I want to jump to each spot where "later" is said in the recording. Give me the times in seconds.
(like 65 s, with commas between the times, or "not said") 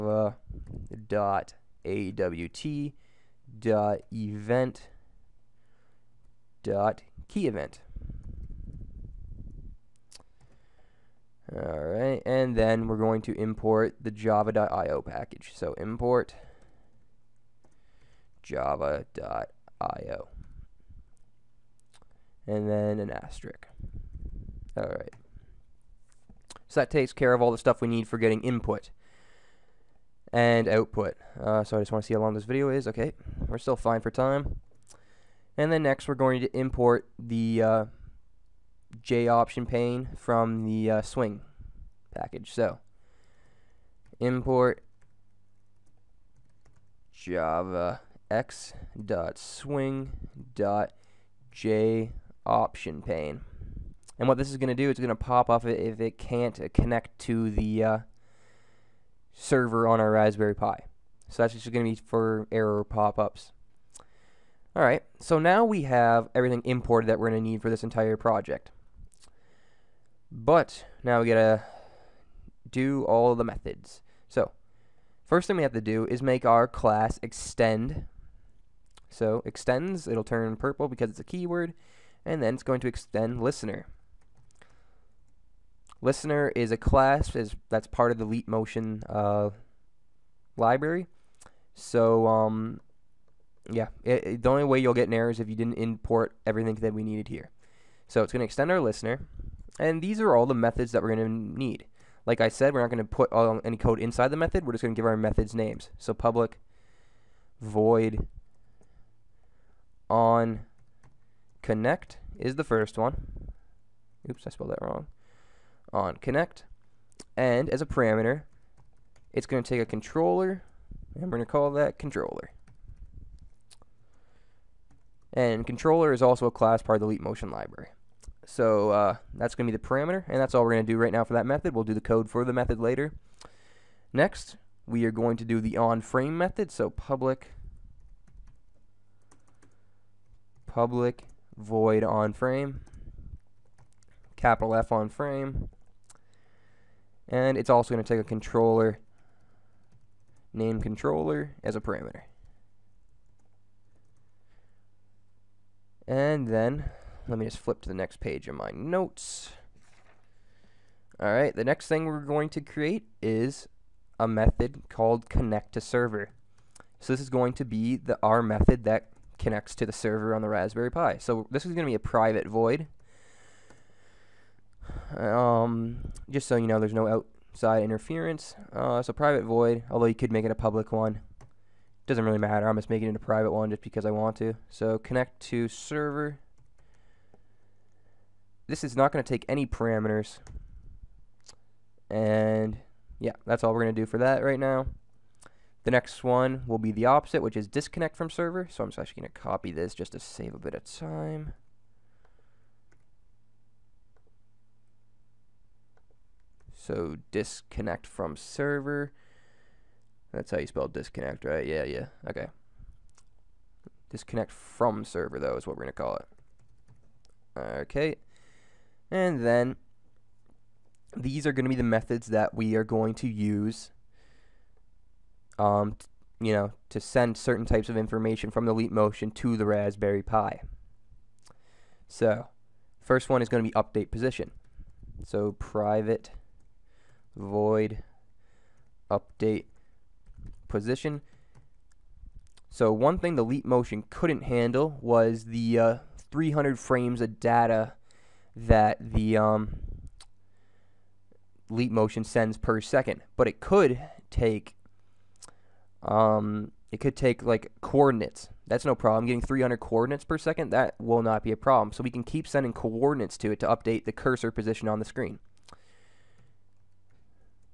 132 s.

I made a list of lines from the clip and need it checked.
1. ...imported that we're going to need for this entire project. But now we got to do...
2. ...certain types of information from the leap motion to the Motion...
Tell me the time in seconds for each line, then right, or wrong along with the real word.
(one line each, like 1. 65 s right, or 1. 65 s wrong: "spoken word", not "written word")
1. 66 s right
2. 227 s wrong: "Raspberry", not "Motion".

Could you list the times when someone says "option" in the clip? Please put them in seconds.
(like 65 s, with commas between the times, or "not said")
39 s, 52 s.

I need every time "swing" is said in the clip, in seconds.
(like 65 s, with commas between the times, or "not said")
41 s, 49 s.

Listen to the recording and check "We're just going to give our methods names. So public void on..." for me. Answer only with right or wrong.
right.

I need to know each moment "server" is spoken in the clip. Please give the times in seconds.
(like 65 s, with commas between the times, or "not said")
59 s, 165 s, 169 s, 185 s, 198 s, 208 s, 215 s.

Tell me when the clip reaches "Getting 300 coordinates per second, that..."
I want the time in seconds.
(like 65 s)
259 s.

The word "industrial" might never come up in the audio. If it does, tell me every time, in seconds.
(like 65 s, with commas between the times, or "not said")
not said.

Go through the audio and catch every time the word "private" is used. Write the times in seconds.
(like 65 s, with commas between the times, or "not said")
171 s, 179 s, 183 s, 235 s.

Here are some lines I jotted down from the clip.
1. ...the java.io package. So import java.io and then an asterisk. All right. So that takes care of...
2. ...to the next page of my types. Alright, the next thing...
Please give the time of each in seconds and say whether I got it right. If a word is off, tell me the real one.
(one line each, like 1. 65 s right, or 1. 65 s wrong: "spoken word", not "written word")
1. 14 s right
2. 157 s wrong: "notes", not "types".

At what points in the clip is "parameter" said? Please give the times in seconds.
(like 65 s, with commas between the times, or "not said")
117 s, 129 s, 151 s, 189 s.